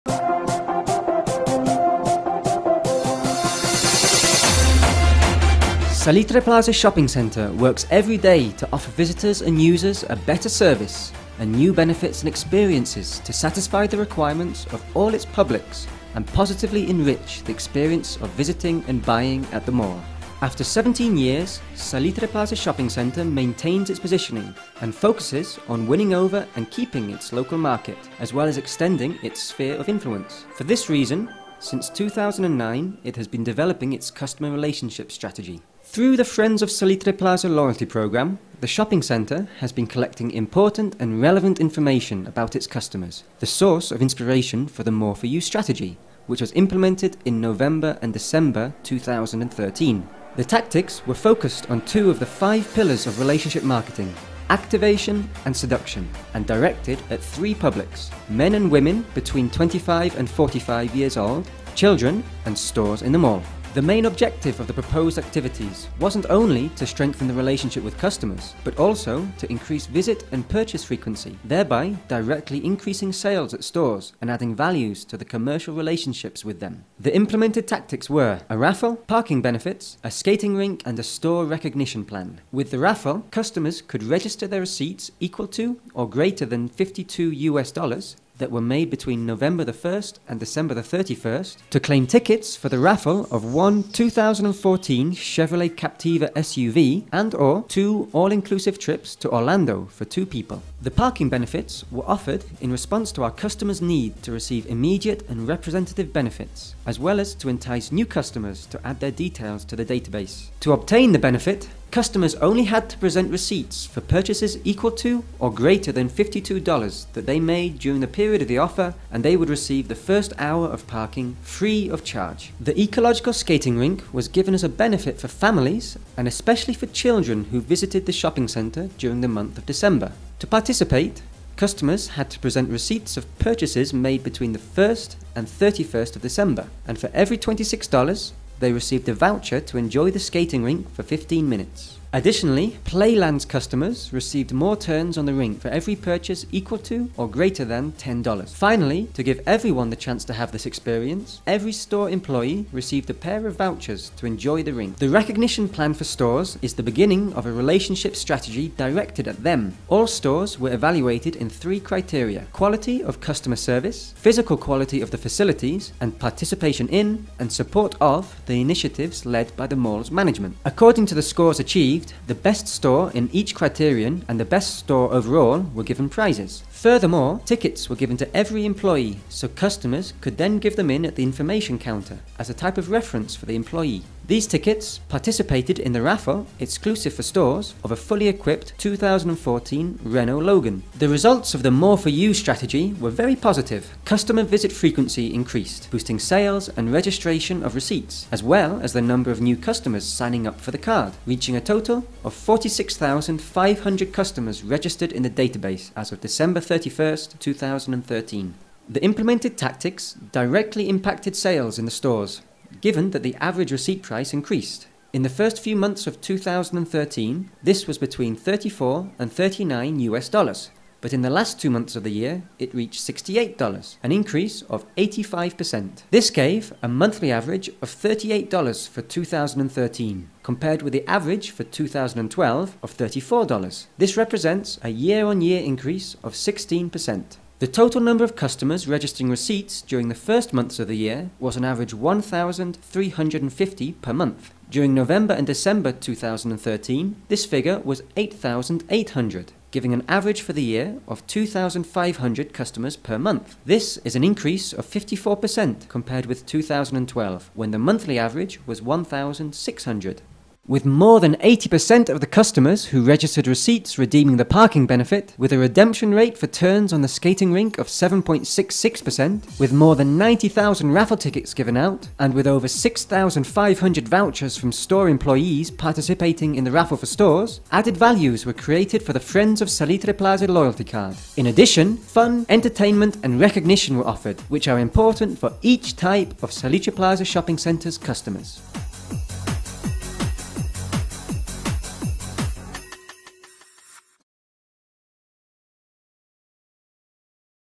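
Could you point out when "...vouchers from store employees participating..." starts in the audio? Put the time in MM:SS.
04:34.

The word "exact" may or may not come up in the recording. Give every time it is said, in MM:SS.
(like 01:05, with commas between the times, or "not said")
not said.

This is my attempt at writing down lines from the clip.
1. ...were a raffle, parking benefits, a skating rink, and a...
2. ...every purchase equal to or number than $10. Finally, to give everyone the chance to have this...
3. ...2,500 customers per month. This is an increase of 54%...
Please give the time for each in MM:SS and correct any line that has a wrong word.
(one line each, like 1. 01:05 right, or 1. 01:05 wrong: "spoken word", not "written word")
1. 01:18 right
2. 02:25 wrong: "greater", not "number"
3. 04:11 right.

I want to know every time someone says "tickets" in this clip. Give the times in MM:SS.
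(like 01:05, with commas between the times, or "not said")
01:32, 02:57, 03:04, 04:31.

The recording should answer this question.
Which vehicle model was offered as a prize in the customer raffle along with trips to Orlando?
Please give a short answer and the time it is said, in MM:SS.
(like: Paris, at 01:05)
Chevrolet Captiva, at 01:35.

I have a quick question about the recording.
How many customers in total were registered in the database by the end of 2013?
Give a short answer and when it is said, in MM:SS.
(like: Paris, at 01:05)
46,500, at 03:22.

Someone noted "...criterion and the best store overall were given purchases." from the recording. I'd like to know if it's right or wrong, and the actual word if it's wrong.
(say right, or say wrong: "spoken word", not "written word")
wrong: "prizes", not "purchases".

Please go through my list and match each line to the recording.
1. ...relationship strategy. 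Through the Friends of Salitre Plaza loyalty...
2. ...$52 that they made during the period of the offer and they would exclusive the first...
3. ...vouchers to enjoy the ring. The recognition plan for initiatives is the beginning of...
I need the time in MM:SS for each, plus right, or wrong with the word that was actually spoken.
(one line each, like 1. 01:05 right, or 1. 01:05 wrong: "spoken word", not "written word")
1. 00:34 right
2. 01:56 wrong: "receive", not "exclusive"
3. 02:33 wrong: "stores", not "initiatives".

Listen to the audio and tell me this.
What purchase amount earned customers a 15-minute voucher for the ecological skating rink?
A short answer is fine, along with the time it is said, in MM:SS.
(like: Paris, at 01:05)
$26, at 02:17.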